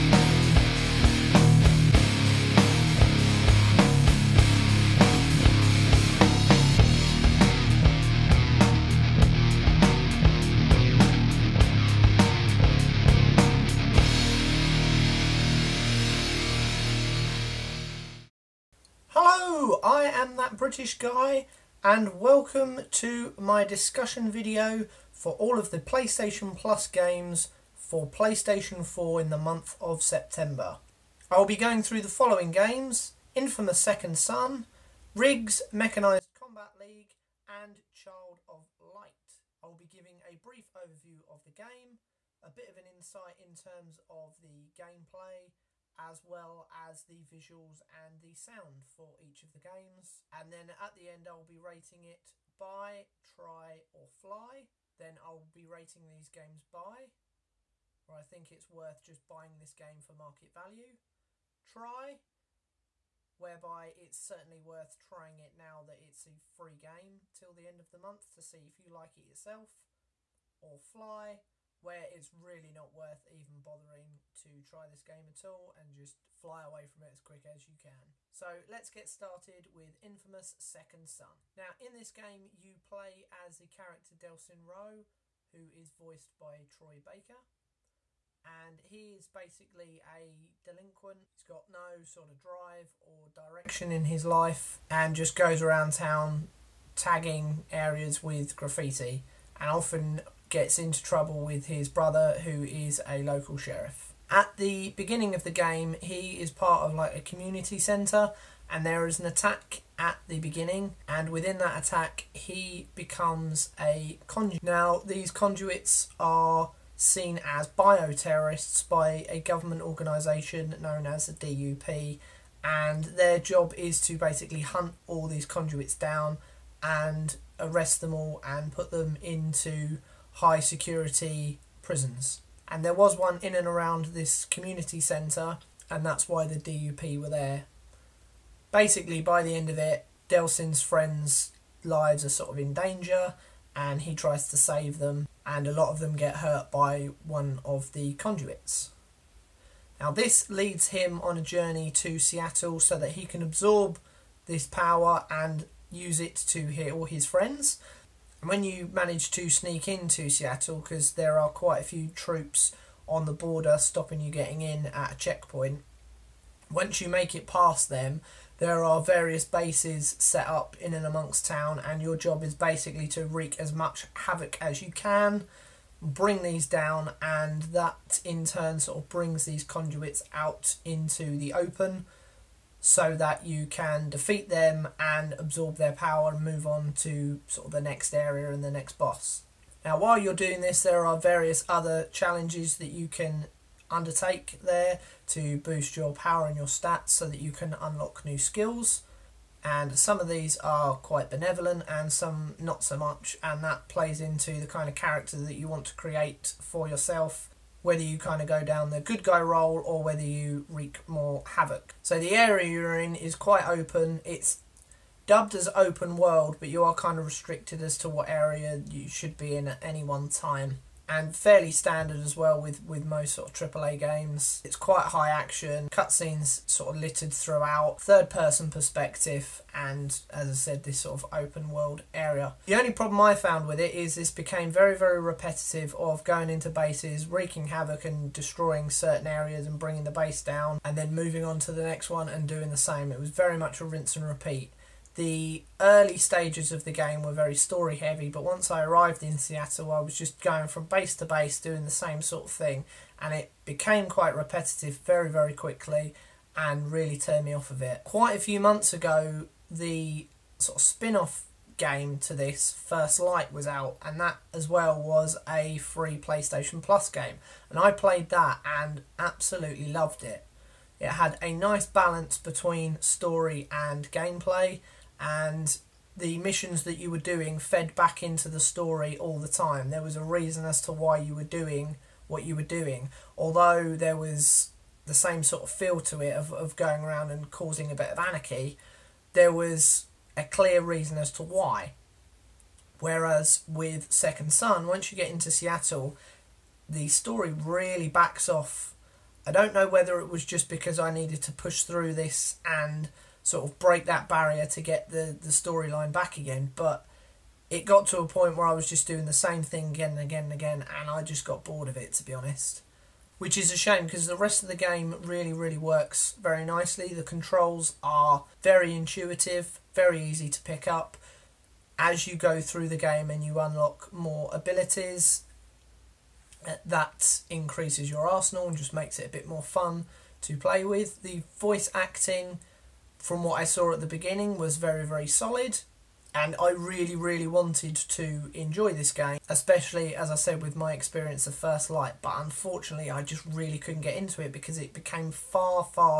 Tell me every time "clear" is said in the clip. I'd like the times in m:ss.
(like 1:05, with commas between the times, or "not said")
4:50.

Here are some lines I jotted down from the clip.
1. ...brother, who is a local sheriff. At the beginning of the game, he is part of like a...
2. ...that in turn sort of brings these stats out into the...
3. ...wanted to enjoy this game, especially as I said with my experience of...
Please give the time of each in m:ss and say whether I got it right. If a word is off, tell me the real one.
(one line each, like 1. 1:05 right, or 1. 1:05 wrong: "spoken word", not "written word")
1. 1:41 right
2. 2:57 wrong: "conduits", not "stats"
3. 5:37 right.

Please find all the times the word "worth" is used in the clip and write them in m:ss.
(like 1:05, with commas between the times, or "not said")
0:58, 1:04, 1:12.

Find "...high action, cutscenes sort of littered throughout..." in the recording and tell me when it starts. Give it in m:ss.
3:45.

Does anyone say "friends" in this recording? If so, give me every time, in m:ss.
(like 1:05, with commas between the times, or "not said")
2:20, 2:37.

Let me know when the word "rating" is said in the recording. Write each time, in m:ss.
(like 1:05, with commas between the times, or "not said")
0:51, 0:55.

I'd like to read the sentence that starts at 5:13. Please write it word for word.
Which is a shame because the rest of the game really, really works very nicely.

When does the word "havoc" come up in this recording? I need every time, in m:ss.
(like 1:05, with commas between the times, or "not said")
2:54, 3:31, 3:57.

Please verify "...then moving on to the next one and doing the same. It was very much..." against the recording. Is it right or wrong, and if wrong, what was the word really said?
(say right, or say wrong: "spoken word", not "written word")
right.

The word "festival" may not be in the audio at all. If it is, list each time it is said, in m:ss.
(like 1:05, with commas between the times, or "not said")
not said.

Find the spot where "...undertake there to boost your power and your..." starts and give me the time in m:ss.
3:13.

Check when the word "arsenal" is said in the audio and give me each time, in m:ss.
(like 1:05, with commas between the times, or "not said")
5:28.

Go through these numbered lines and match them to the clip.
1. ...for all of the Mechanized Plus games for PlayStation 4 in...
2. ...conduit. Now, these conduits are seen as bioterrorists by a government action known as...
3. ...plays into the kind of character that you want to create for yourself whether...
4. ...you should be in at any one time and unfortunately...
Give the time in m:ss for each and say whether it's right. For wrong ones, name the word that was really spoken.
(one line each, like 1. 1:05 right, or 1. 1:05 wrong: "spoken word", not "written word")
1. 0:25 wrong: "PlayStation", not "Mechanized"
2. 1:54 wrong: "organisation", not "action"
3. 3:23 right
4. 3:38 wrong: "fairly", not "unfortunately".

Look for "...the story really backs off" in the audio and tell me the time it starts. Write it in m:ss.
4:56.